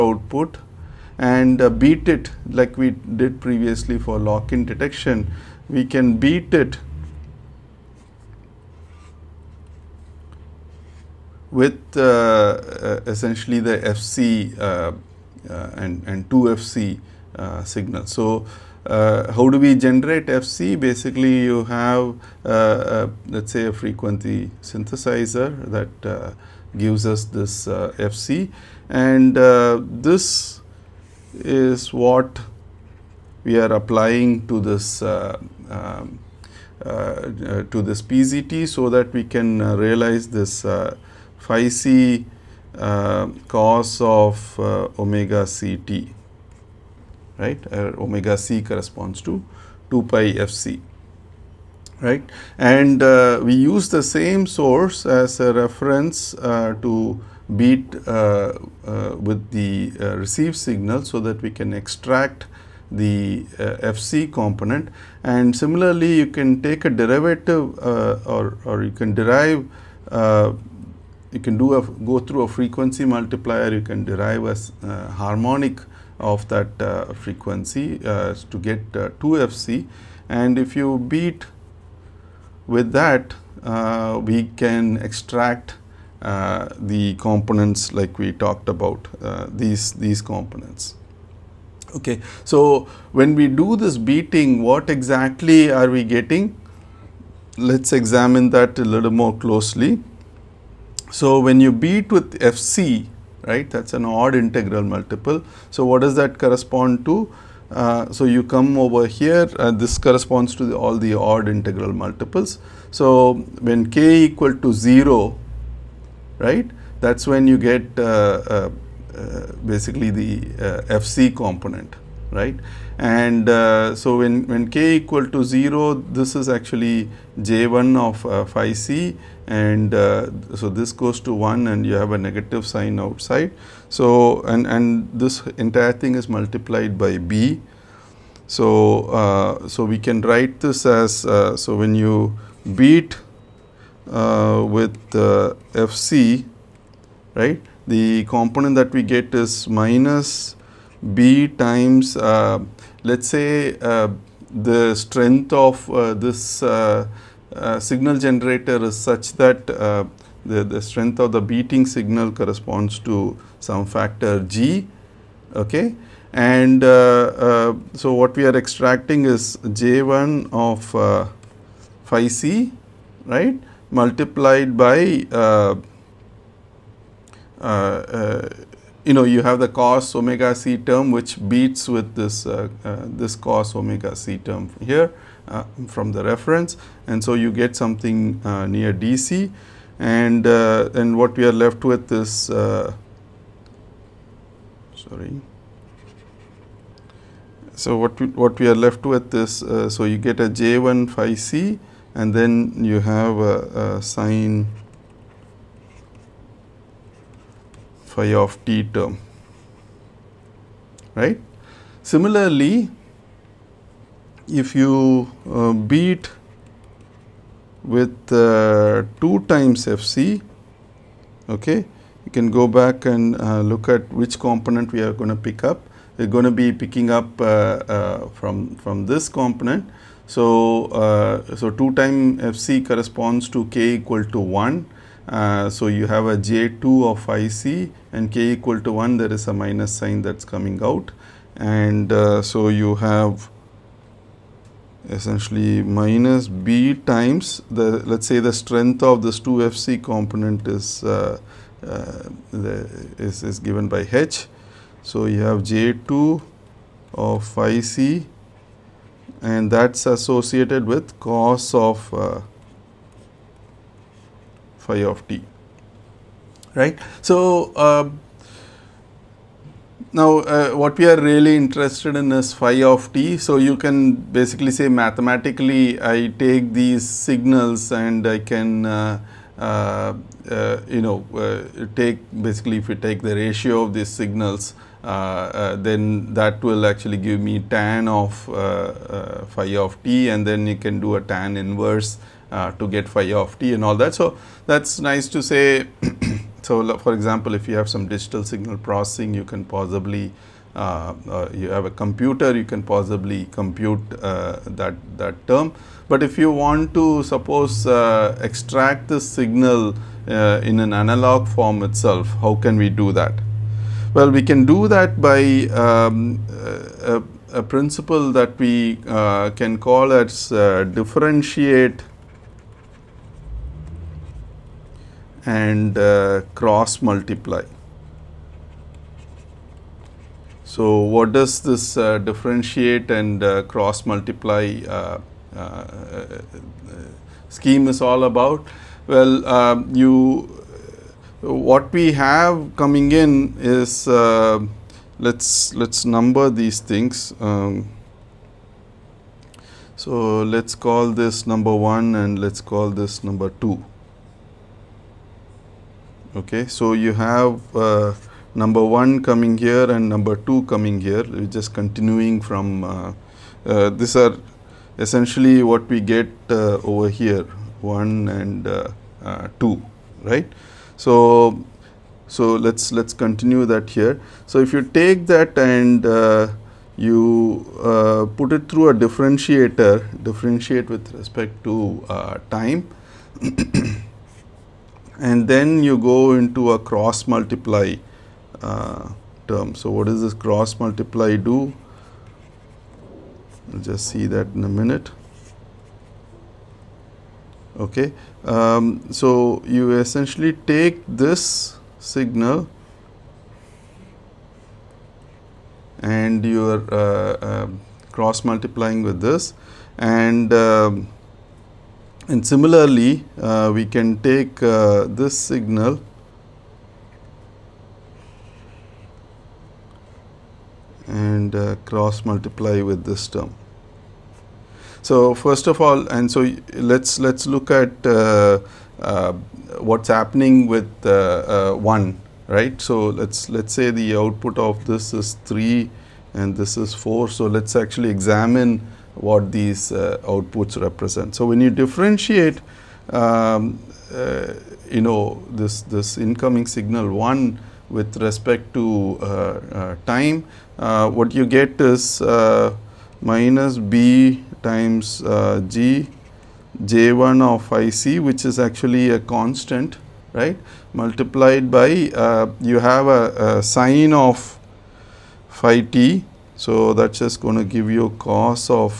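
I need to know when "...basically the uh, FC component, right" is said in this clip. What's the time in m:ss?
1:59.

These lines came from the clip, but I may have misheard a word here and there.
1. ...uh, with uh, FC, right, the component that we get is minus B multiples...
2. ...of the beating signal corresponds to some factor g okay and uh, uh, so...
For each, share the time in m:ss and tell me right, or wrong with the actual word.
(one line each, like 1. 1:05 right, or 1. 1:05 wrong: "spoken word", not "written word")
1. 2:24 wrong: "times", not "multiples"
2. 2:41 right.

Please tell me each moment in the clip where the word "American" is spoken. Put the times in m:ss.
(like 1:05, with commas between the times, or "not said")
not said.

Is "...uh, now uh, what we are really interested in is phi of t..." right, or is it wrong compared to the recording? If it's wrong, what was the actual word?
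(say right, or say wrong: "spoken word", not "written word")
right.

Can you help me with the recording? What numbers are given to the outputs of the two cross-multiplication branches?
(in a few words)
3 and 4.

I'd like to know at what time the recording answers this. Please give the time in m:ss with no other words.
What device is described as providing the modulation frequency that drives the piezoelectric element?
0:23.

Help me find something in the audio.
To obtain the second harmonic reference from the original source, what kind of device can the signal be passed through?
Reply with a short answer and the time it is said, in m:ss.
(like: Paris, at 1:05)
frequency multiplier, at 1:12.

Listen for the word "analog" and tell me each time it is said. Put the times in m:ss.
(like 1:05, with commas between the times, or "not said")
5:10.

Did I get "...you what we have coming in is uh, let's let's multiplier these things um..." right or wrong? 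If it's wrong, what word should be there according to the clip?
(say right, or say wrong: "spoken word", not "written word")
wrong: "number", not "multiplier".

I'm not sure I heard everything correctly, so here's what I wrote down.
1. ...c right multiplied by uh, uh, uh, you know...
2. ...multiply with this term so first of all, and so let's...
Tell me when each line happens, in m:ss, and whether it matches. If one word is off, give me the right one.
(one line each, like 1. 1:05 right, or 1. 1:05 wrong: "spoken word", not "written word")
1. 2:52 right
2. 7:02 right.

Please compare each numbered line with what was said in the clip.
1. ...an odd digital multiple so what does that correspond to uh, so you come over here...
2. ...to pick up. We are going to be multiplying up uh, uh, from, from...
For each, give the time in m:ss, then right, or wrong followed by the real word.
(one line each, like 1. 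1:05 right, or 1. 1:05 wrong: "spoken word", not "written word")
1. 1:43 wrong: "integral", not "digital"
2. 3:45 wrong: "picking", not "multiplying".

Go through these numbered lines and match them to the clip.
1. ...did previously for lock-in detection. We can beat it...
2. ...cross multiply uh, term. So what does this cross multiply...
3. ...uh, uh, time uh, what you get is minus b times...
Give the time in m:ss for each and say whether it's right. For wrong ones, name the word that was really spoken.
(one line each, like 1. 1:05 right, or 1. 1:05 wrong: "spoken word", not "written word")
1. 0:02 right
2. 6:26 right
3. 7:29 right.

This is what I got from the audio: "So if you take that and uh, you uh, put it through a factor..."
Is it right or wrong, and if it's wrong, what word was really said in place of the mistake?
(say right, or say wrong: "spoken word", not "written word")
wrong: "differentiator", not "factor".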